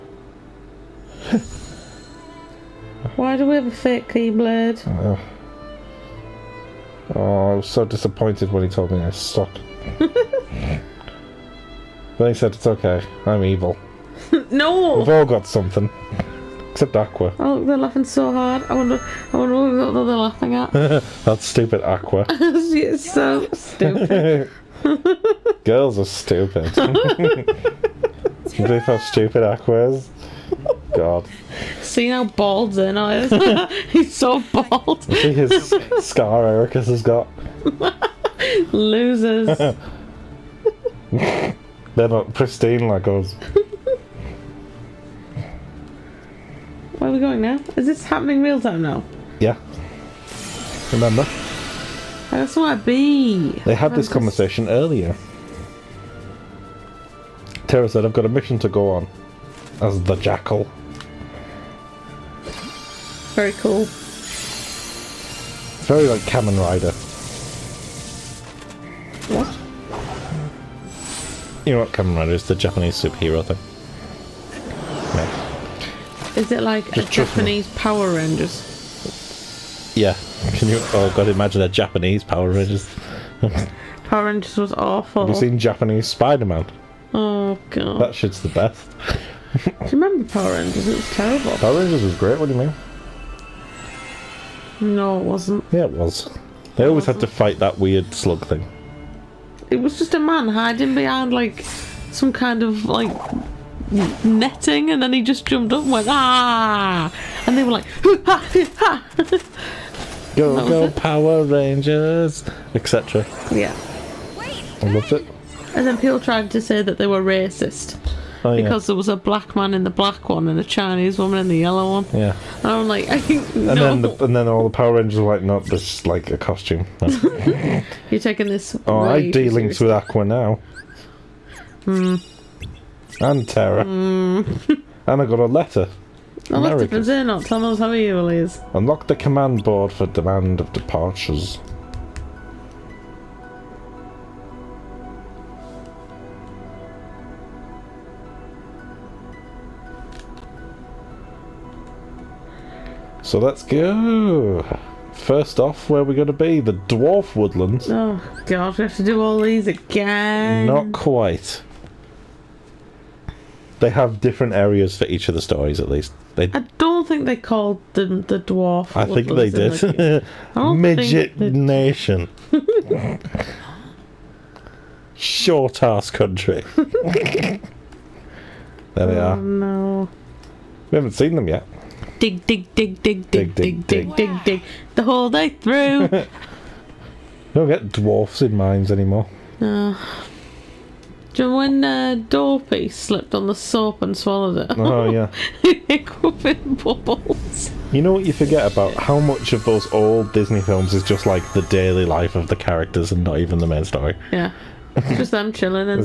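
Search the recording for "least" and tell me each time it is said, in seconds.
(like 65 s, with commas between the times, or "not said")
165 s.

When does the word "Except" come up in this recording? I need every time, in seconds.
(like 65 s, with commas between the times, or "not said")
16 s.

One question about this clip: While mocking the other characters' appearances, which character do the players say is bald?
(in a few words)
Zeno.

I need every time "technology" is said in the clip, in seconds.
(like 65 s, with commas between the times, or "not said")
not said.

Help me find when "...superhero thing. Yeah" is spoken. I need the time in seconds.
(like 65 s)
73 s.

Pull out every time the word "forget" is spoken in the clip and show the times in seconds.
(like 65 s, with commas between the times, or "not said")
198 s.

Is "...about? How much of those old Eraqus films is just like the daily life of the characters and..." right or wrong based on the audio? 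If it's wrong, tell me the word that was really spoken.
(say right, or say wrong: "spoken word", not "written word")
wrong: "Disney", not "Eraqus".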